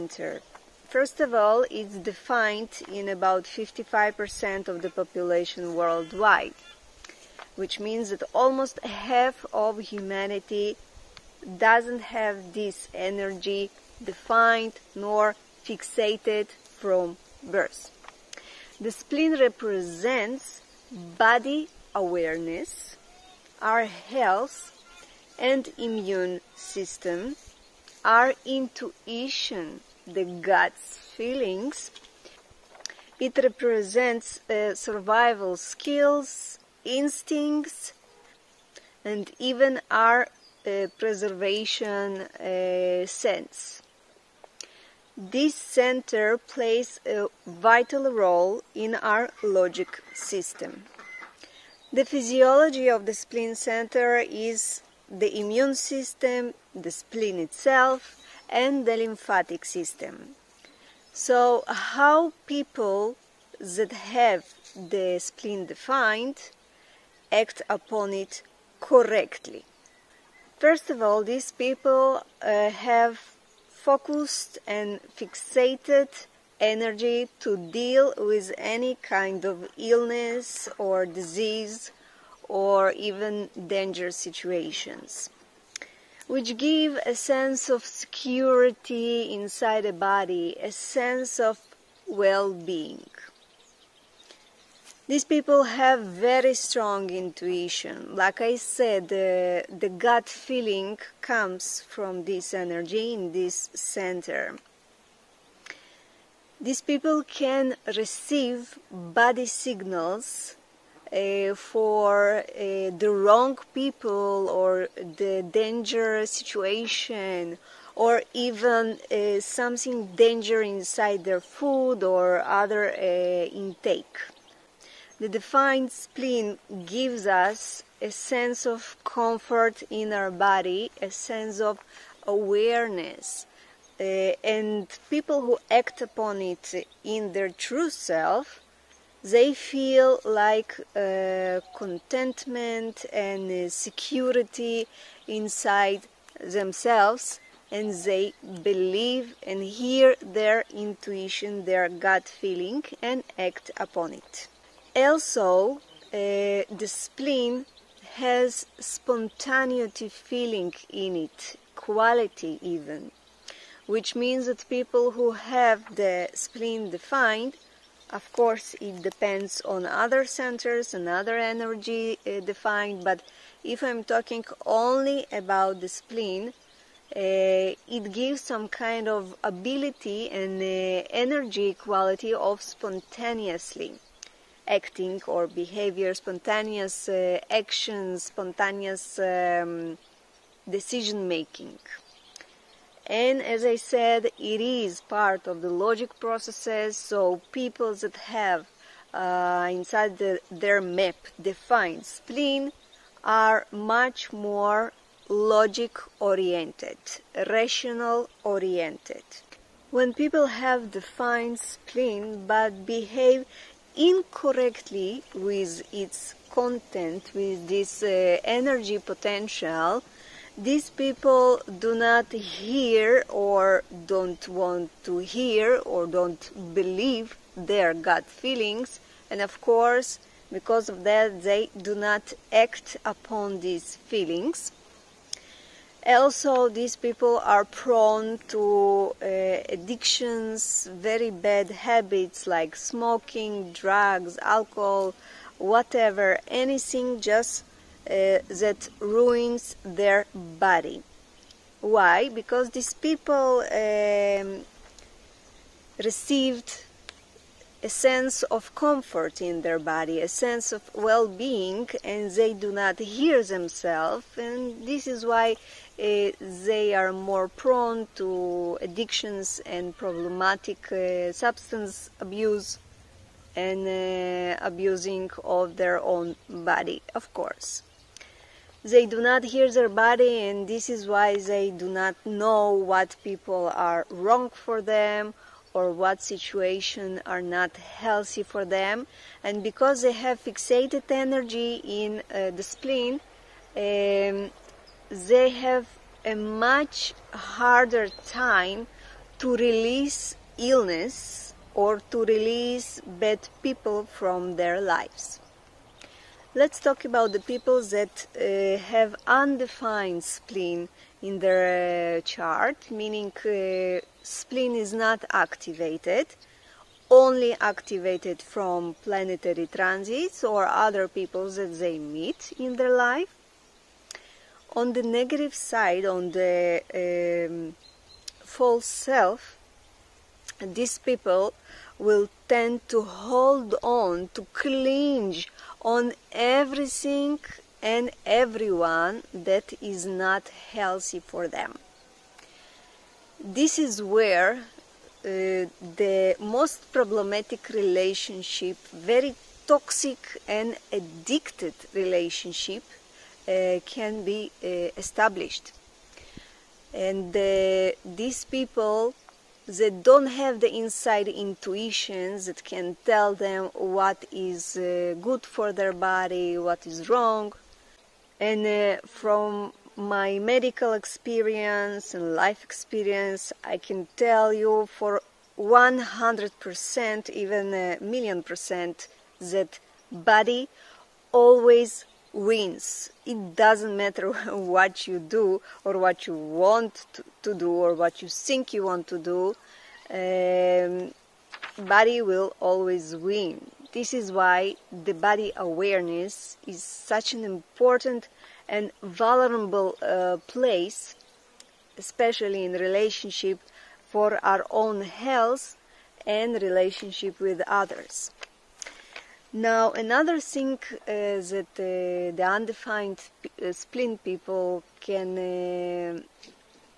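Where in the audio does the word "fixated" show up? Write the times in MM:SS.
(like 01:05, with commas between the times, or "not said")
00:15, 01:15, 04:50.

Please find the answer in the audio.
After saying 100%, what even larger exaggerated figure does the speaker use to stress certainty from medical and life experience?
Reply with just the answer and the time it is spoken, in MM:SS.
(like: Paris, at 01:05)
a million percent, at 06:17.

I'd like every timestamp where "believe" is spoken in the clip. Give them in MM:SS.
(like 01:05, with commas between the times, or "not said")
02:28, 03:46.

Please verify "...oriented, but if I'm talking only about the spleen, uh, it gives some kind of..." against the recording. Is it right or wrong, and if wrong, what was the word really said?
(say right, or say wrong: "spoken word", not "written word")
wrong: "defined", not "oriented".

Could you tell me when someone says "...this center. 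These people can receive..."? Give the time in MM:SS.
01:43.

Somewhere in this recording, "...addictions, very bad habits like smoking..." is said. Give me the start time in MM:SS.
03:59.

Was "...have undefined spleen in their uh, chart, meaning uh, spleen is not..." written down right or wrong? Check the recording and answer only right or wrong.
right.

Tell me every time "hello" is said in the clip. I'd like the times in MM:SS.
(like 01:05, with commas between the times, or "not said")
not said.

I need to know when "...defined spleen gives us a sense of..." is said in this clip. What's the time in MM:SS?
02:05.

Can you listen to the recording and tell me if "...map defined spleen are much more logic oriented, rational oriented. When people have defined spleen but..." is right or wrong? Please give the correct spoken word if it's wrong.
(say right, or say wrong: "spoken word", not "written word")
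right.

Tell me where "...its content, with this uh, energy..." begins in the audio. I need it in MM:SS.
03:35.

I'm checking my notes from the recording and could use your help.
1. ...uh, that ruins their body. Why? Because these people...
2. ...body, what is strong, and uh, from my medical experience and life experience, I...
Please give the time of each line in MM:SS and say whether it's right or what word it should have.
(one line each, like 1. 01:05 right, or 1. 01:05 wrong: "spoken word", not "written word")
1. 04:08 right
2. 06:05 wrong: "wrong", not "strong".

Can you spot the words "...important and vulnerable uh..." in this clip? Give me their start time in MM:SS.
06:37.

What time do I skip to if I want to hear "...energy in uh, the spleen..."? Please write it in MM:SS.
04:51.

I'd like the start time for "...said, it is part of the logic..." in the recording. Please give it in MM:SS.
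03:13.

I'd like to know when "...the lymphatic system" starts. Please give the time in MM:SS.
00:58.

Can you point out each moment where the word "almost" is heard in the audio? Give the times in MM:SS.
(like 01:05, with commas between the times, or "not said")
00:08.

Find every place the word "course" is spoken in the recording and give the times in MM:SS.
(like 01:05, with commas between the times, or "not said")
02:48, 03:49, 04:37.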